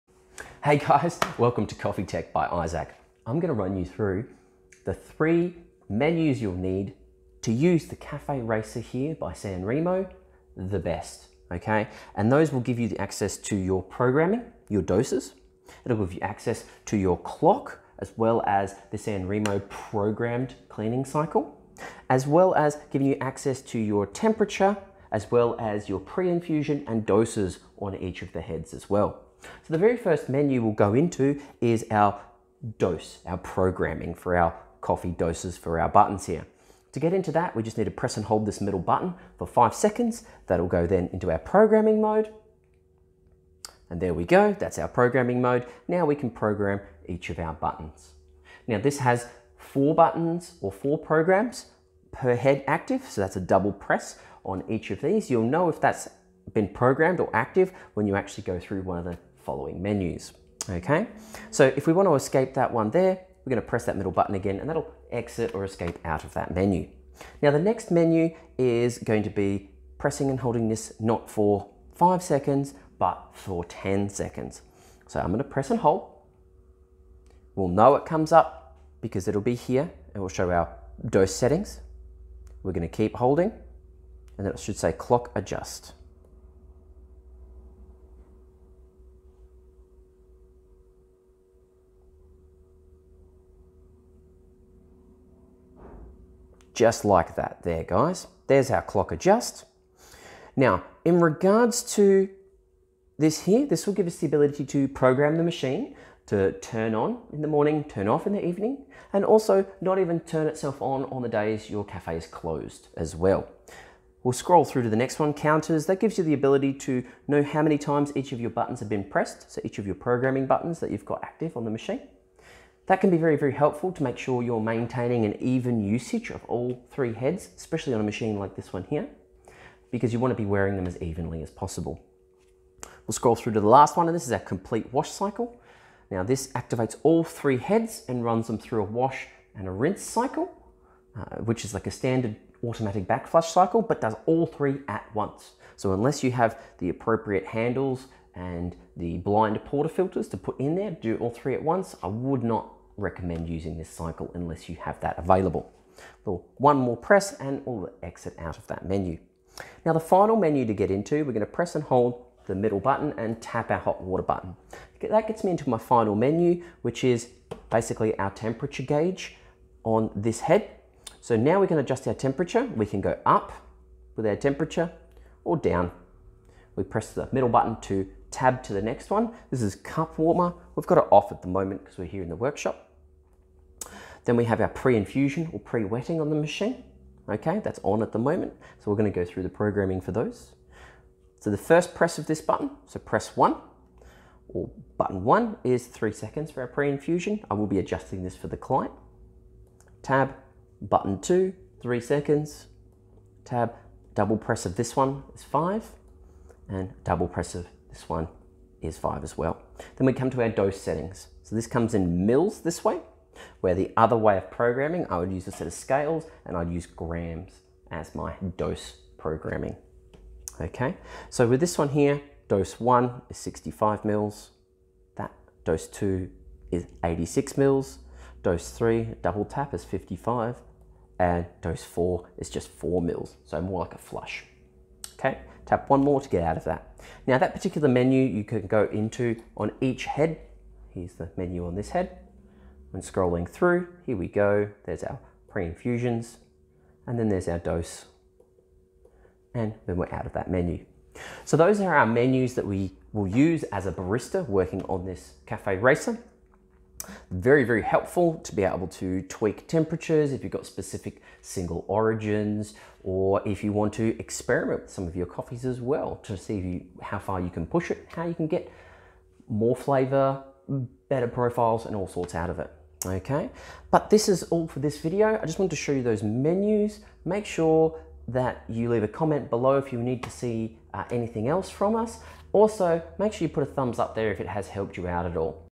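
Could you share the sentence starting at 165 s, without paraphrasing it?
That gets me into my final menu, which is basically our temperature gauge on this head.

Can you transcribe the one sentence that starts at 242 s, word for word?
When scrolling through, here we go.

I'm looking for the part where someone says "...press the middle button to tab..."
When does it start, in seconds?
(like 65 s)
176 s.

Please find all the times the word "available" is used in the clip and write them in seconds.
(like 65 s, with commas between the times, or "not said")
155 s.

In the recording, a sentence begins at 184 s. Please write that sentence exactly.
Then we have our pre-infusion or pre-wetting on the machine.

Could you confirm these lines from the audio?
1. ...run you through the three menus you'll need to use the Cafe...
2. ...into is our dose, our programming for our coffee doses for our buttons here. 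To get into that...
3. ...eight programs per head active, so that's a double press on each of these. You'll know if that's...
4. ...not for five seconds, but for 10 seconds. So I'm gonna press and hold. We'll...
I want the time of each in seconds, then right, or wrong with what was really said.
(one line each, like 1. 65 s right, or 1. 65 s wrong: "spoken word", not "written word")
1. 3 s right
2. 30 s right
3. 50 s wrong: "four", not "eight"
4. 70 s right.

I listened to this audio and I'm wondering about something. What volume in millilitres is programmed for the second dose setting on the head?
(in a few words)
86 mils.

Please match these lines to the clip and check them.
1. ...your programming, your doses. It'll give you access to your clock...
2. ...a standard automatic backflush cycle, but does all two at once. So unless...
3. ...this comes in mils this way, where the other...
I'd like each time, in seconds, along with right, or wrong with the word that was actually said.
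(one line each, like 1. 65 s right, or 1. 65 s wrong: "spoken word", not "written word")
1. 13 s right
2. 141 s wrong: "three", not "two"
3. 211 s right.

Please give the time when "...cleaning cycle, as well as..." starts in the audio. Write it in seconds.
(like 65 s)
20 s.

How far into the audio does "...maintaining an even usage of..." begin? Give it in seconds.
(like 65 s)
124 s.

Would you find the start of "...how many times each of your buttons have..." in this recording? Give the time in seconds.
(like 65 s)
117 s.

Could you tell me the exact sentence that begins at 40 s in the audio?
That'll go then into our programming mode.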